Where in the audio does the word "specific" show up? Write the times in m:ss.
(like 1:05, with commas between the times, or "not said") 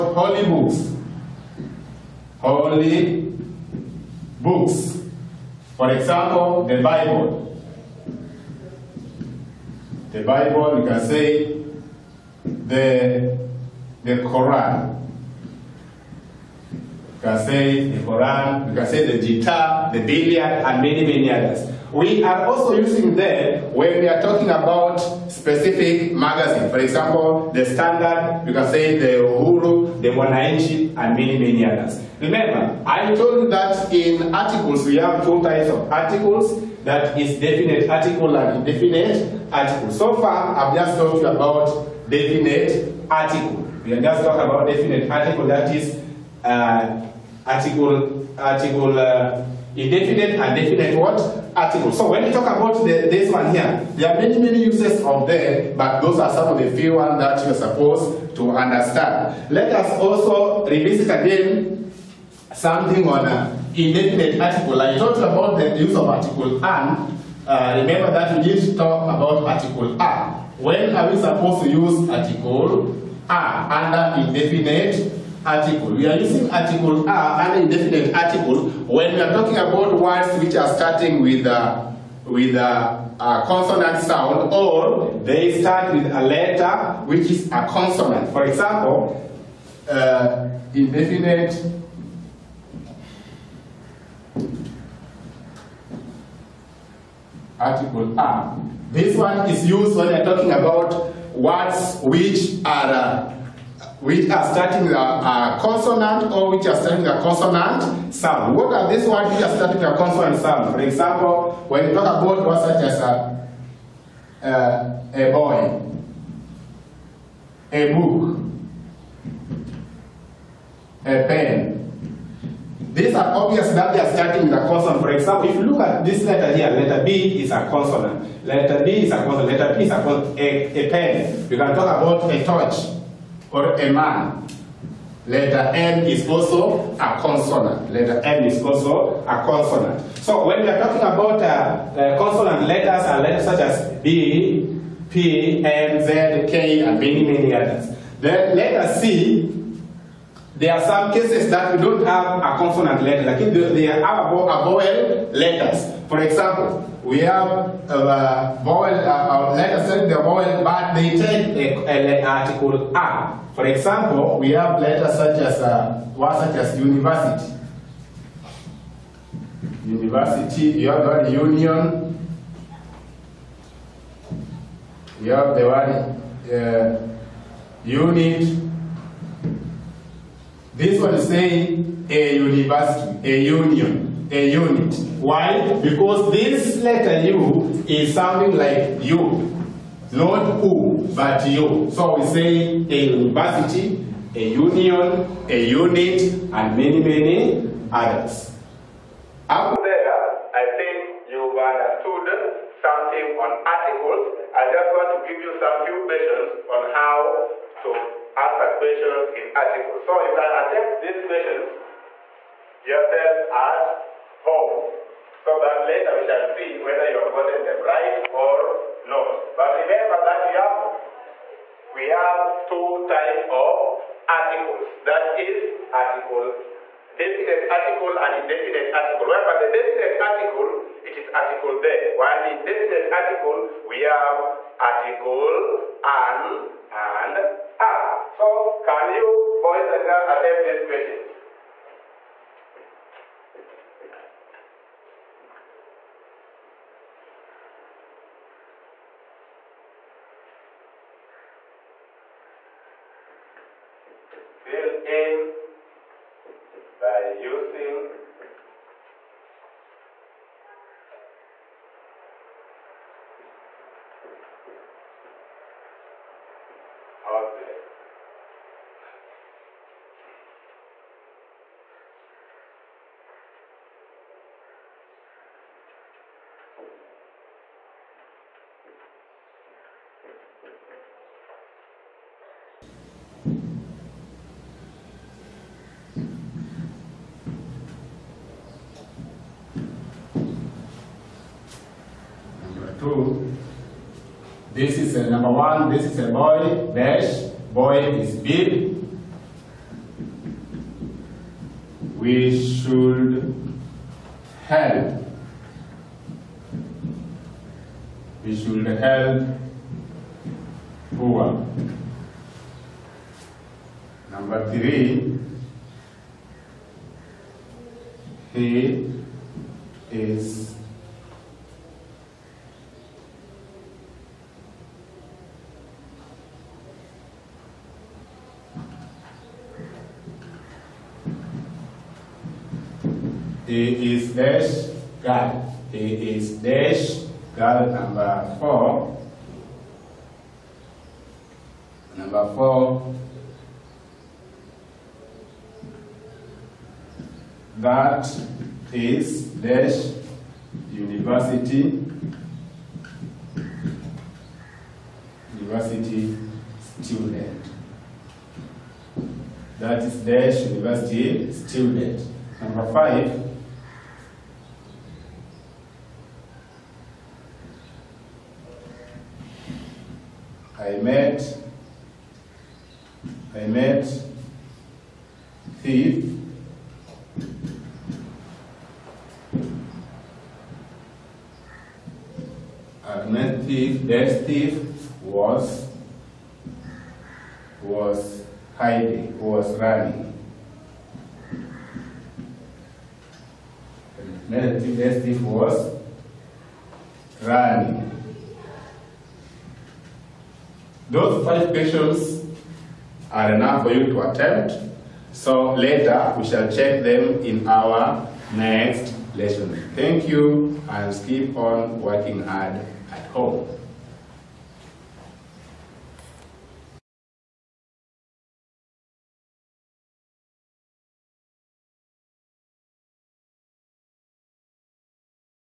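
0:25.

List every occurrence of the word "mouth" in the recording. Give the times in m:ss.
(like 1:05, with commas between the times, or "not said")
not said.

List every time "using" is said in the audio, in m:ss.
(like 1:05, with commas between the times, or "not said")
0:22, 1:16, 4:17.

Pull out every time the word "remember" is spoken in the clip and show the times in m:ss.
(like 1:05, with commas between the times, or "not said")
0:32, 1:07, 3:39.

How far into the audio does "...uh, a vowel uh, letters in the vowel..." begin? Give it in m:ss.
2:37.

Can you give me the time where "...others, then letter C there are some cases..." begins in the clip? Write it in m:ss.
2:27.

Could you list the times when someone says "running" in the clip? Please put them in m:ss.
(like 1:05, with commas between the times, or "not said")
6:29, 6:37.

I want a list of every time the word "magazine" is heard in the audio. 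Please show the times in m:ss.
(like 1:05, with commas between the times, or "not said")
0:26.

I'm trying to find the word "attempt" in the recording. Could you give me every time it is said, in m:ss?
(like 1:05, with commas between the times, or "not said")
3:30, 4:00, 6:44.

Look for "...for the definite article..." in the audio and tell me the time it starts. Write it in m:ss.
3:49.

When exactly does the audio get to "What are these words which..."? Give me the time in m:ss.
1:48.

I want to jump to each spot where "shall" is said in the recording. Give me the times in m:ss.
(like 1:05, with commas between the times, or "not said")
3:36, 6:46.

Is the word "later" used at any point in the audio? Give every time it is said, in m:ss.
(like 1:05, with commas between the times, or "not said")
3:35, 6:45.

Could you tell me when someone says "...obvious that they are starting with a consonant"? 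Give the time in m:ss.
2:03.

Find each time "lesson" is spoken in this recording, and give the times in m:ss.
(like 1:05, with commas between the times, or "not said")
6:49.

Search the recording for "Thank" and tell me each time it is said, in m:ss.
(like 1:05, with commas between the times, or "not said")
6:49.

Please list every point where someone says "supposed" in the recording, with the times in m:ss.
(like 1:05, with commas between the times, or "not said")
0:57, 1:11.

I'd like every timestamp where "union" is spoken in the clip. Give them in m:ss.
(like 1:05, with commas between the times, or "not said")
2:51, 3:03, 3:14.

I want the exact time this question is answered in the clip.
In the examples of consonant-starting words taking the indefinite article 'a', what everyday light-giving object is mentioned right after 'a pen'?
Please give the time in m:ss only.
2:12.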